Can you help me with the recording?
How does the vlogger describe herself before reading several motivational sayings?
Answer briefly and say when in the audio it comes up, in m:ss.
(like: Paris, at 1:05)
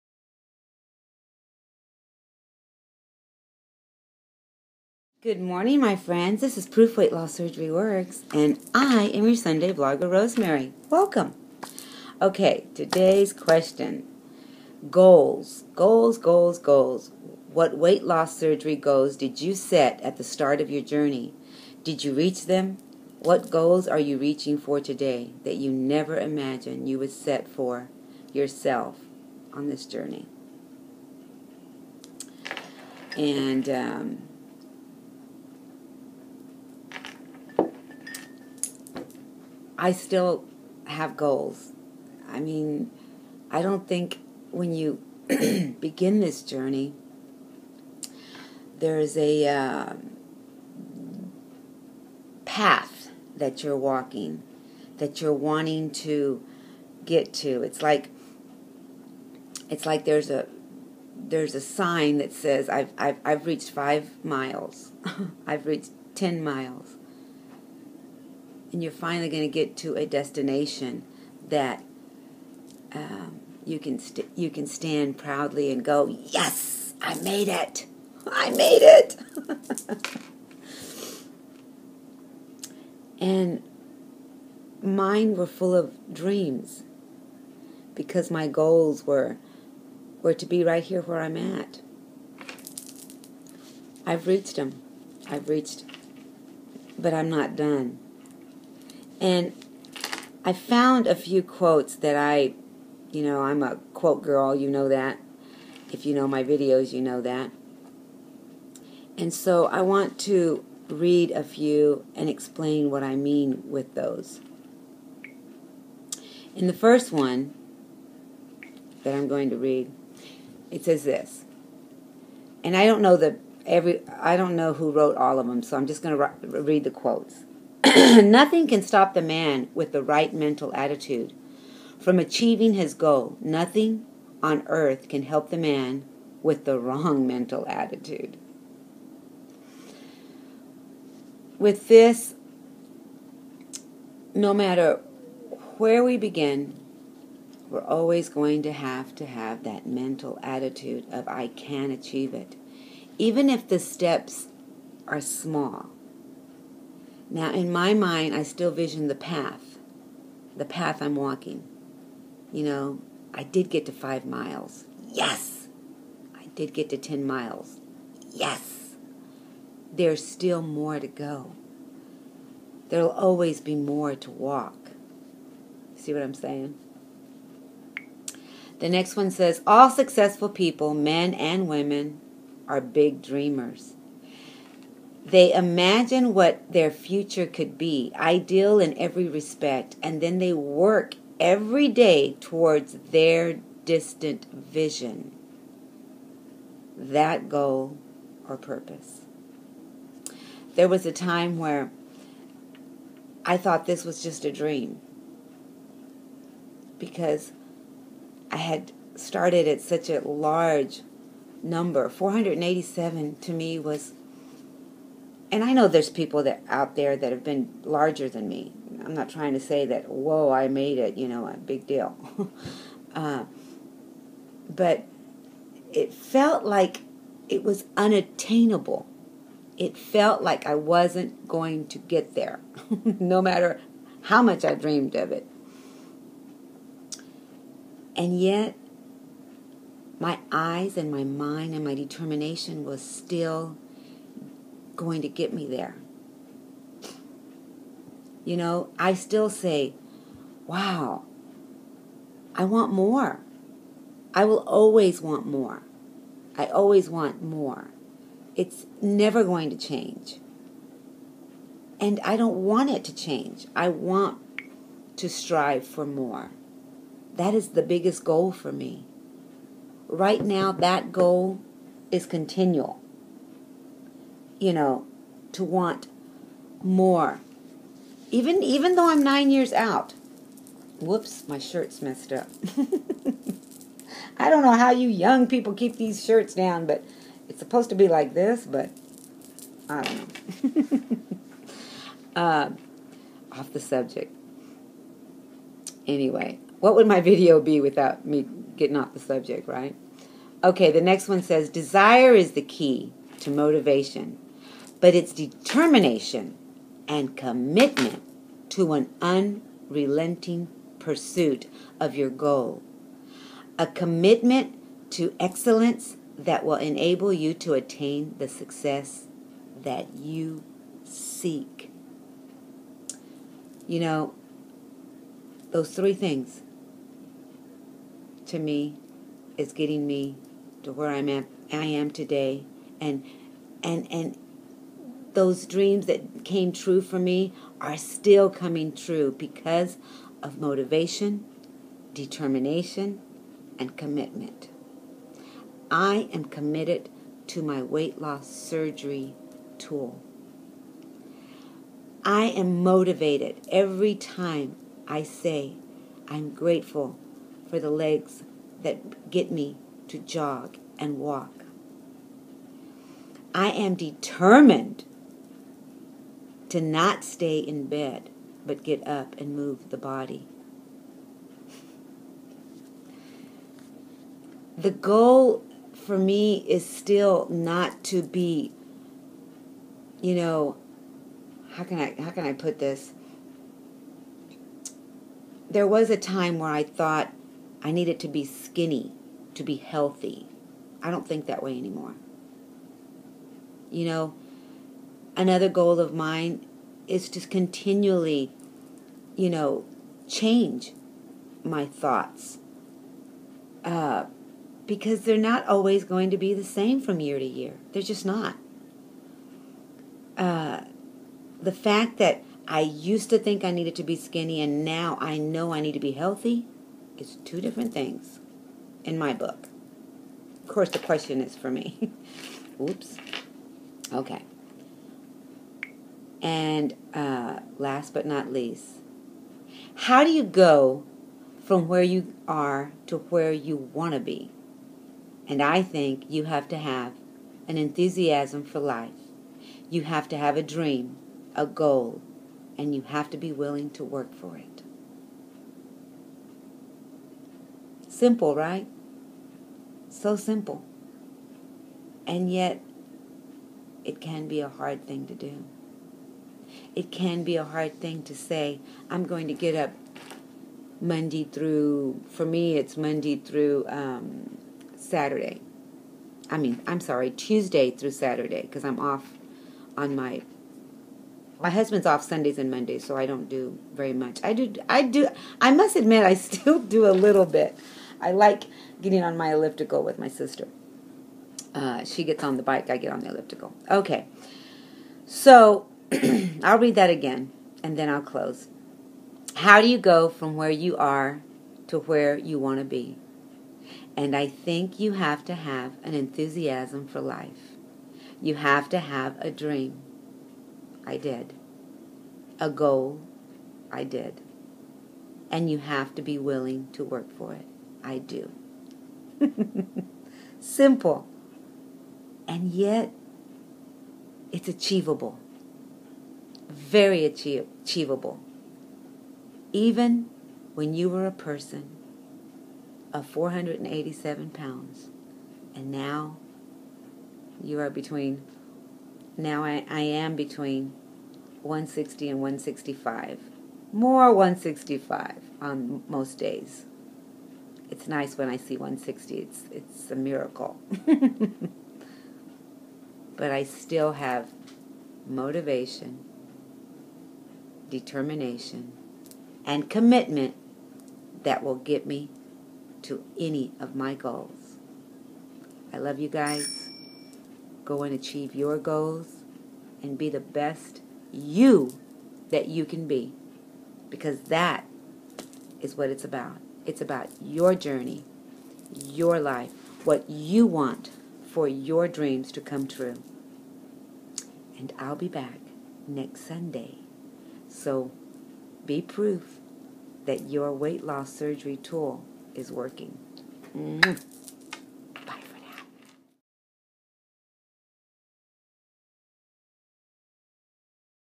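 a quote girl, at 1:43.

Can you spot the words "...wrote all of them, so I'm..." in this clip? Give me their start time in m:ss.
2:04.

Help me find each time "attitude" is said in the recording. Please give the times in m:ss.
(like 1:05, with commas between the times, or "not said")
2:10, 2:17, 2:30.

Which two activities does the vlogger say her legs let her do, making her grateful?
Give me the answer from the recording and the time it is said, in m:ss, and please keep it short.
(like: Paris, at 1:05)
jog and walk, at 6:00.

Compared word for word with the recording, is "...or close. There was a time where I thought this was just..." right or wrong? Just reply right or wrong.
wrong.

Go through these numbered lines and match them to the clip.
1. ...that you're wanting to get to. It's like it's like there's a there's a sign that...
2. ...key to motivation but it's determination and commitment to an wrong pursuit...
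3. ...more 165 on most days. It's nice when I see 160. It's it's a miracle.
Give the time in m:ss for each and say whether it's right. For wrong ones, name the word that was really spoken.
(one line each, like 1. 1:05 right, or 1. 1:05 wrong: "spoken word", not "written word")
1. 0:54 right
2. 5:02 wrong: "unrelenting", not "wrong"
3. 8:53 right.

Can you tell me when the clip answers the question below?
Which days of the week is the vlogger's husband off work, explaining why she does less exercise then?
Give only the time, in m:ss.
7:52.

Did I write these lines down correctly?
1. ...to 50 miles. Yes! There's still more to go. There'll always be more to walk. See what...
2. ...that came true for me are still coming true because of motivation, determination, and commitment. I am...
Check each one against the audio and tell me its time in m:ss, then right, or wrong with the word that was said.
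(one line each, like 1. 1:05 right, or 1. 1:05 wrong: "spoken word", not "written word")
1. 2:46 wrong: "10", not "50"
2. 5:36 right.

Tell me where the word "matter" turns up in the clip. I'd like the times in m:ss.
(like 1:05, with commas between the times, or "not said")
2:24, 3:53.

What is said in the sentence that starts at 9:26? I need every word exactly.
It's about your journey, your life, what you want for your dreams to come true.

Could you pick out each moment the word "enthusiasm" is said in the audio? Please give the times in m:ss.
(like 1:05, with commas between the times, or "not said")
7:17, 8:16.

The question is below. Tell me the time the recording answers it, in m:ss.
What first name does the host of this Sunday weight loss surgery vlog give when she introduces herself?
0:10.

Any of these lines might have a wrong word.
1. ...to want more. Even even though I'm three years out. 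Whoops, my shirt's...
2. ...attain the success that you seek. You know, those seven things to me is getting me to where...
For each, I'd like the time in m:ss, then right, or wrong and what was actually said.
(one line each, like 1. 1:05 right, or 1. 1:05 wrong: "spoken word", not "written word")
1. 4:35 wrong: "nine", not "three"
2. 5:17 wrong: "three", not "seven".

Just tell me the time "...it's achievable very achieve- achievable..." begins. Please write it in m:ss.
8:34.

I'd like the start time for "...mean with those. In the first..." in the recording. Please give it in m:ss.
1:53.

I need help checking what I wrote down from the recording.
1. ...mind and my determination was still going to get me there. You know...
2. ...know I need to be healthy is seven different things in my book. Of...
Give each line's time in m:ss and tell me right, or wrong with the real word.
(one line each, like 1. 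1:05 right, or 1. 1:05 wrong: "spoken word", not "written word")
1. 4:01 right
2. 6:55 wrong: "two", not "seven".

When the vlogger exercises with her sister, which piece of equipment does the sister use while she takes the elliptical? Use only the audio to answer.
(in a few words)
the bike.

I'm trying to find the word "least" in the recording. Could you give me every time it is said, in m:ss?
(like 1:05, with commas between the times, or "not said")
7:08.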